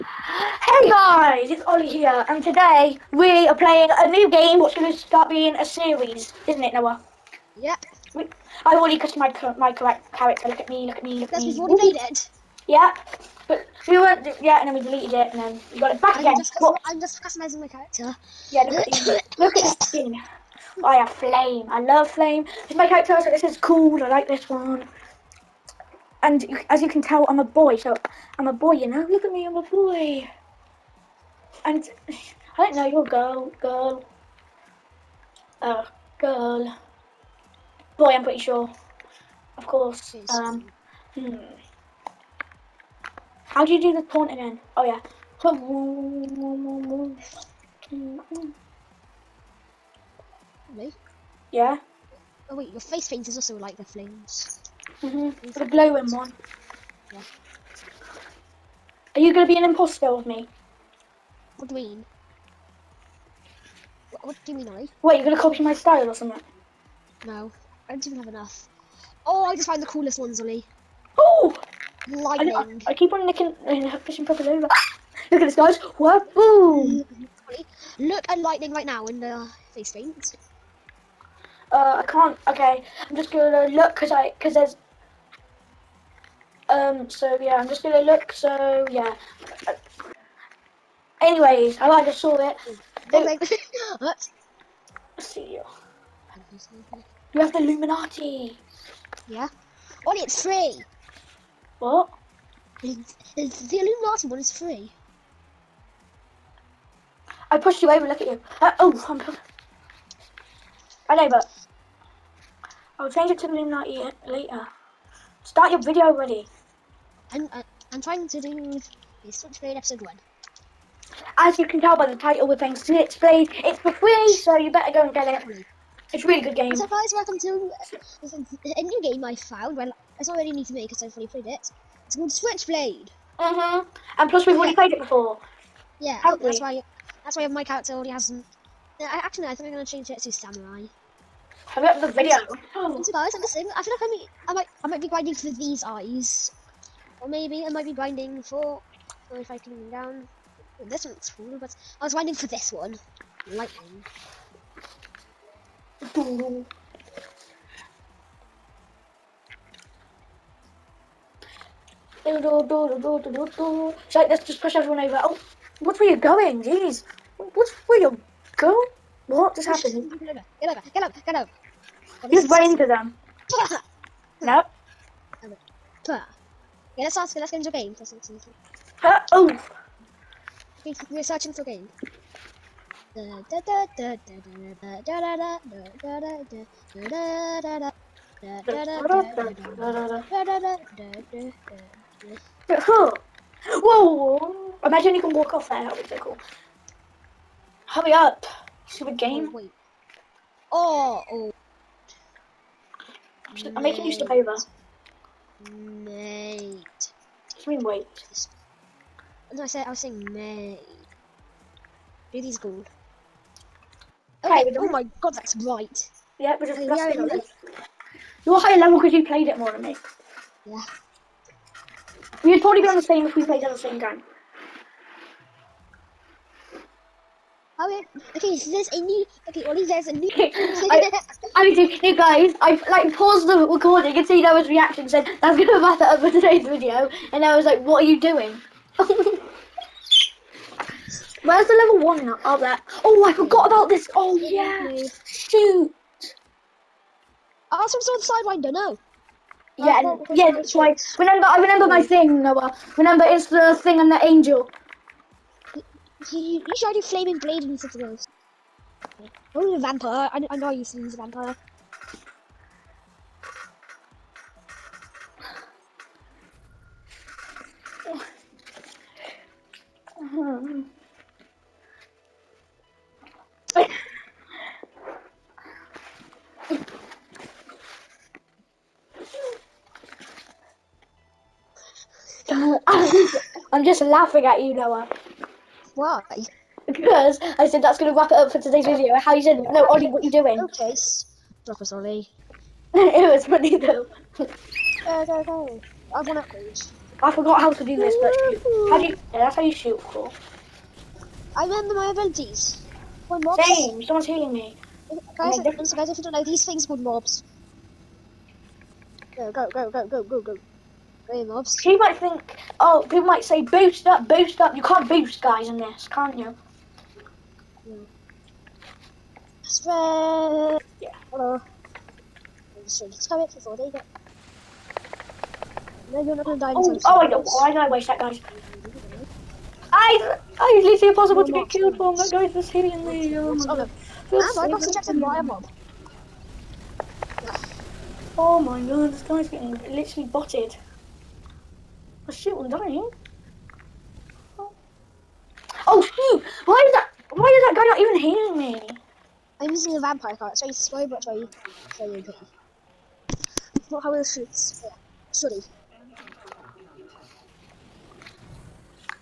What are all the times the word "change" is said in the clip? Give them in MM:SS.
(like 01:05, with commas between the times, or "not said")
01:53, 02:19.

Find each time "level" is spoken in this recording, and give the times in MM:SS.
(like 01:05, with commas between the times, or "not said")
03:38, 04:01.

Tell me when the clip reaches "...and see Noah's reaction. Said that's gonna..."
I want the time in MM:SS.
03:54.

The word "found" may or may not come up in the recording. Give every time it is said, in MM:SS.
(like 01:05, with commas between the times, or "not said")
01:09, 02:09.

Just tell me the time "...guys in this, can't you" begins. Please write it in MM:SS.
05:15.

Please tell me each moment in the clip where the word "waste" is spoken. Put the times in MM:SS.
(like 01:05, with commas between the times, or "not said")
05:27.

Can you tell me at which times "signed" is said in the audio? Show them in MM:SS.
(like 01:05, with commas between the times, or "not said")
not said.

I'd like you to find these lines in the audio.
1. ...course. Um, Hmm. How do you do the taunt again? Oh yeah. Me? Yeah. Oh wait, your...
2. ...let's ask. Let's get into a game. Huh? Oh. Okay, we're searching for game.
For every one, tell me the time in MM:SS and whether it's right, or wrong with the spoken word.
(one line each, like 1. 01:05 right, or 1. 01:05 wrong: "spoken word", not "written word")
1. 00:39 right
2. 02:56 right.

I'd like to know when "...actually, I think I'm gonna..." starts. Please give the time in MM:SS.
02:19.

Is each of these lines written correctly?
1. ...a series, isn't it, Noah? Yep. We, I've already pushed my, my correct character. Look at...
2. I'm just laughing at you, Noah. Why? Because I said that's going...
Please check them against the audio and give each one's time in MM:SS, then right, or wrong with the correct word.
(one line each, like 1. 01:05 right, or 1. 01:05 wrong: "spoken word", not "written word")
1. 00:05 wrong: "customized", not "pushed"
2. 04:43 right.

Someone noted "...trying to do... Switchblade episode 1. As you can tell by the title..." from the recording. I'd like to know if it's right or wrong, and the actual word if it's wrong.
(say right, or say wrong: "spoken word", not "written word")
right.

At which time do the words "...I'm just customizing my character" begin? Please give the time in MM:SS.
00:16.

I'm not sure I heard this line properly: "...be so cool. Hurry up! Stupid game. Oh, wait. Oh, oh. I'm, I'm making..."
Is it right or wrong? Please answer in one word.
right.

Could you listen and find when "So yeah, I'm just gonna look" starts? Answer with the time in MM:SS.
01:27.